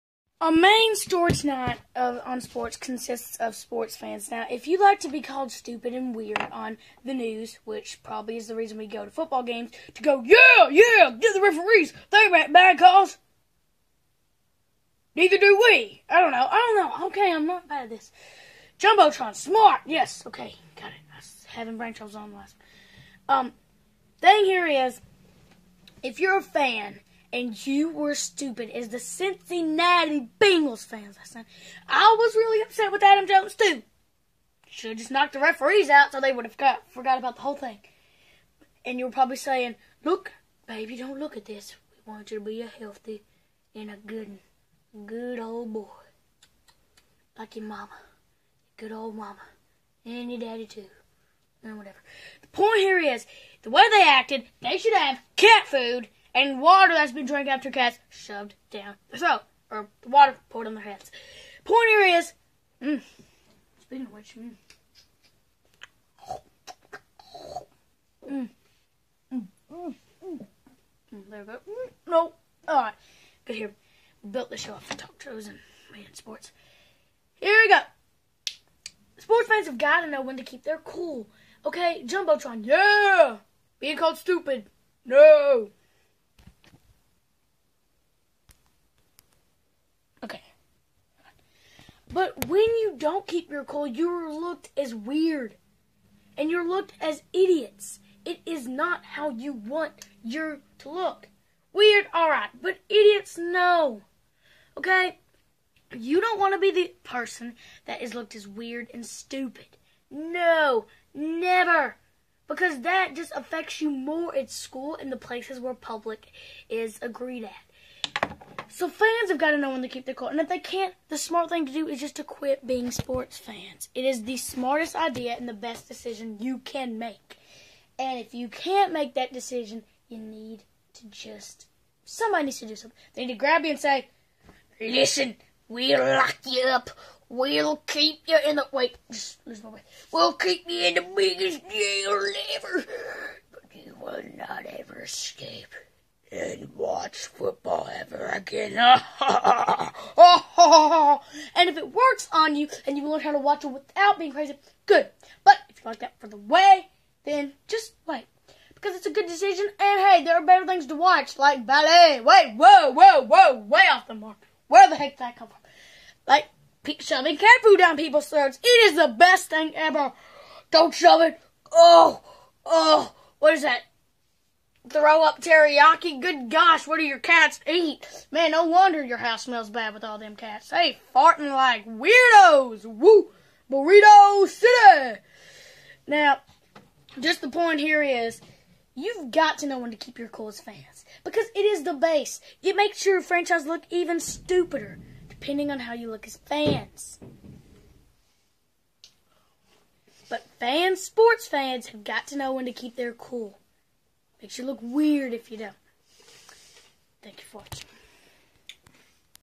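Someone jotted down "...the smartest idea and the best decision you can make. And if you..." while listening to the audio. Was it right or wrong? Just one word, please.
right.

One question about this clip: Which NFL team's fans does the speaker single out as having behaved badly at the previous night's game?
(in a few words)
Cincinnati Bengals.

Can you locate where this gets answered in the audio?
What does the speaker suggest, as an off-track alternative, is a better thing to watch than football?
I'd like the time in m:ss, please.
2:41.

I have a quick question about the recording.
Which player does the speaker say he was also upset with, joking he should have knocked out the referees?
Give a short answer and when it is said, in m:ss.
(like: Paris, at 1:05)
Adam Jones, at 0:33.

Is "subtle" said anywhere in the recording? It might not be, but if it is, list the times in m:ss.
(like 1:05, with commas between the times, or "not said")
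not said.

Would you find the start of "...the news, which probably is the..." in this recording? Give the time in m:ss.
0:07.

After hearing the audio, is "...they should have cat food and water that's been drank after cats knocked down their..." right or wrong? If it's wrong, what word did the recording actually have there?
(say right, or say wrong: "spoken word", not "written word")
wrong: "shoved", not "knocked".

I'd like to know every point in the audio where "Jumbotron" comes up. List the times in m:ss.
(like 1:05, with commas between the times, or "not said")
0:18, 1:22.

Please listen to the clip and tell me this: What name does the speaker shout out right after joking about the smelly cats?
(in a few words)
Burrito City.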